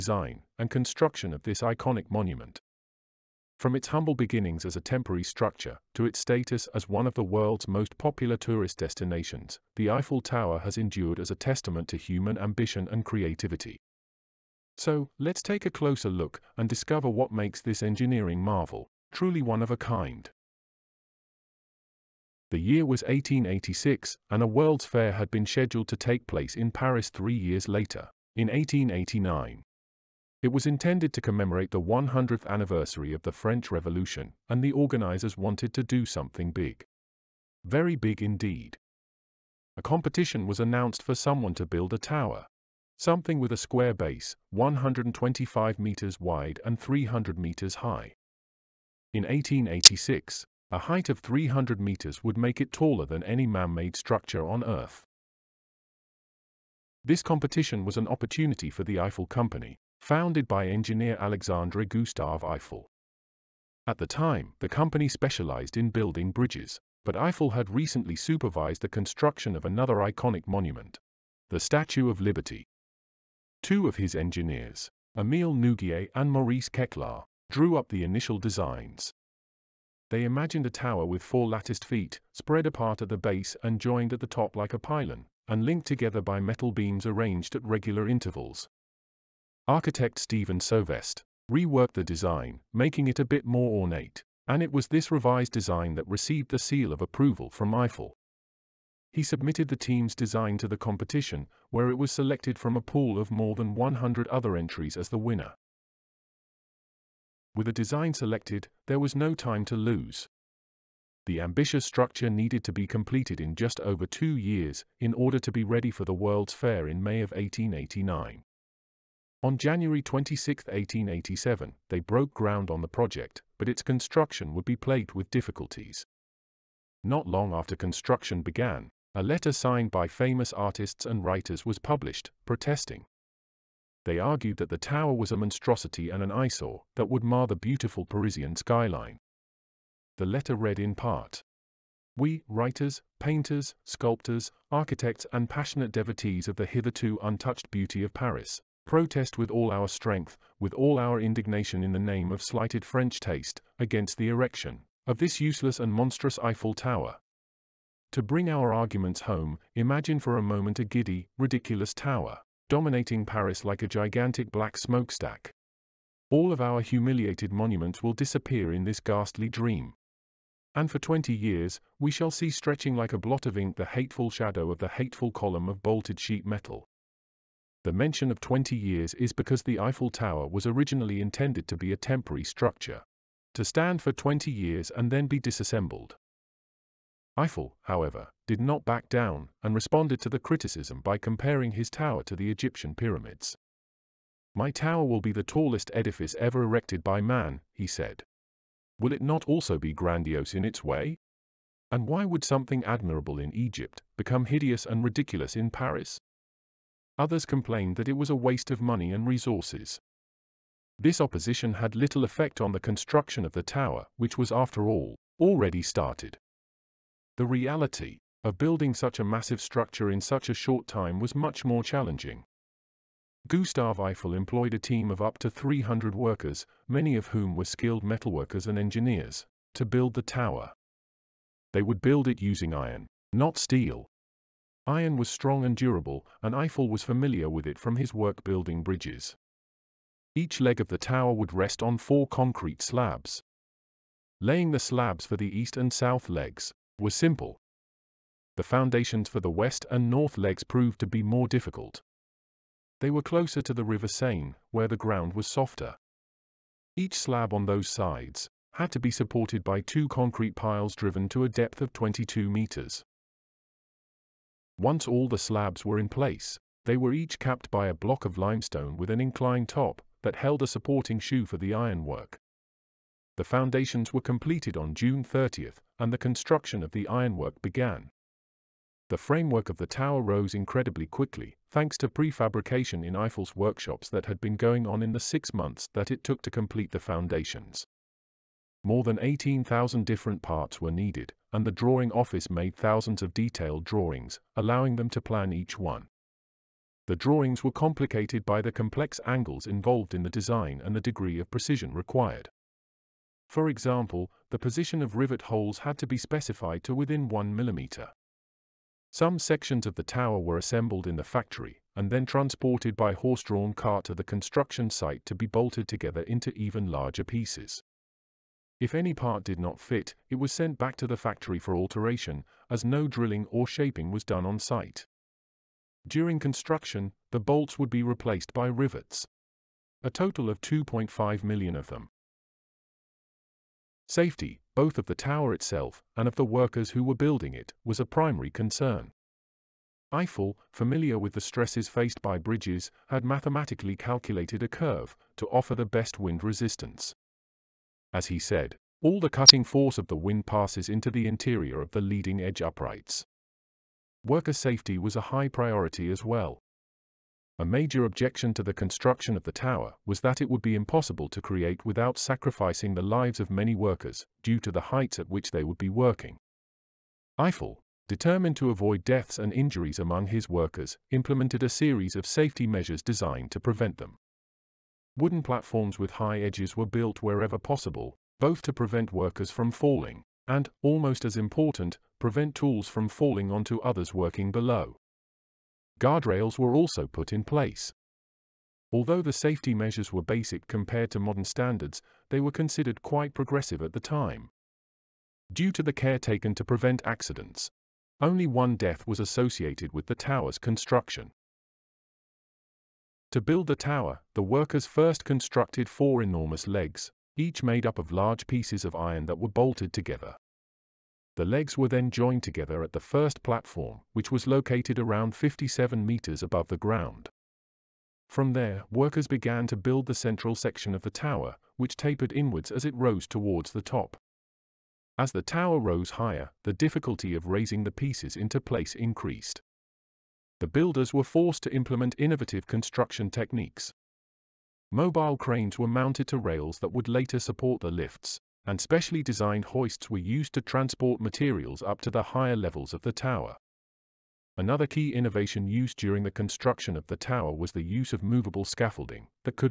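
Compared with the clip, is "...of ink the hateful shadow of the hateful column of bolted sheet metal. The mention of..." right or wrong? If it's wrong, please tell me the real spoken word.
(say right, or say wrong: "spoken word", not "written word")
right.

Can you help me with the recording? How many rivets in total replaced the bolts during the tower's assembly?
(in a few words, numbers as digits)
2.5 million.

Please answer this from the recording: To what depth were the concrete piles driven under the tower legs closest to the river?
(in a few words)
22 meters.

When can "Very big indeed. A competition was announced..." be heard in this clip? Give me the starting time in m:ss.
0:37.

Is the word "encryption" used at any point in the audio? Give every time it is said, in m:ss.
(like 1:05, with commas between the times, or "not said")
not said.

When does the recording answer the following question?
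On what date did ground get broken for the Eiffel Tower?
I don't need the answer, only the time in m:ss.
1:59.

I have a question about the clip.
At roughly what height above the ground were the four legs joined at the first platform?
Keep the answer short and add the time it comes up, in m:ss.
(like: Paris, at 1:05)
57 meters, at 6:55.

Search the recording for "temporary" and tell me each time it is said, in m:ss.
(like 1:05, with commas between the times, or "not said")
0:04, 3:01.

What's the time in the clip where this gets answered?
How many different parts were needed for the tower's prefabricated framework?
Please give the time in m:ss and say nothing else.
4:49.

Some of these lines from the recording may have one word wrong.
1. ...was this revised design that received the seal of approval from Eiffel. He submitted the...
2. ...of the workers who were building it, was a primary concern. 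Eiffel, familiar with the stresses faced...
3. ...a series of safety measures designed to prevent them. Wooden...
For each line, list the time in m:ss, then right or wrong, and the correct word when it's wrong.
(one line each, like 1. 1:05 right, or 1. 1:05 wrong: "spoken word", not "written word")
1. 1:34 right
2. 5:36 right
3. 6:11 right.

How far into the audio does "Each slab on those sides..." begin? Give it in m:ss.
4:16.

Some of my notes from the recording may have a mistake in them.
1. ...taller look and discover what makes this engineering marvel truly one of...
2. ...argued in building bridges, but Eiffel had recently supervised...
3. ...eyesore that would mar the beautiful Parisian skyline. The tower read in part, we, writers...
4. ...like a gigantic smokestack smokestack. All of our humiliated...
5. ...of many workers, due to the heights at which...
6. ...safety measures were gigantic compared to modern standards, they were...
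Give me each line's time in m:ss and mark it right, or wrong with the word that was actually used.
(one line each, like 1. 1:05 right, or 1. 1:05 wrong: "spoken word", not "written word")
1. 0:15 wrong: "closer", not "taller"
2. 1:05 wrong: "specialized", not "argued"
3. 2:16 wrong: "letter", not "tower"
4. 2:43 wrong: "black", not "smokestack"
5. 6:03 right
6. 6:29 wrong: "basic", not "gigantic".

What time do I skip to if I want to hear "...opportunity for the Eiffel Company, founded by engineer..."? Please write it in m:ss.
0:58.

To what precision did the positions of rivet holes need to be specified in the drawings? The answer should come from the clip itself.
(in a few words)
1 mm.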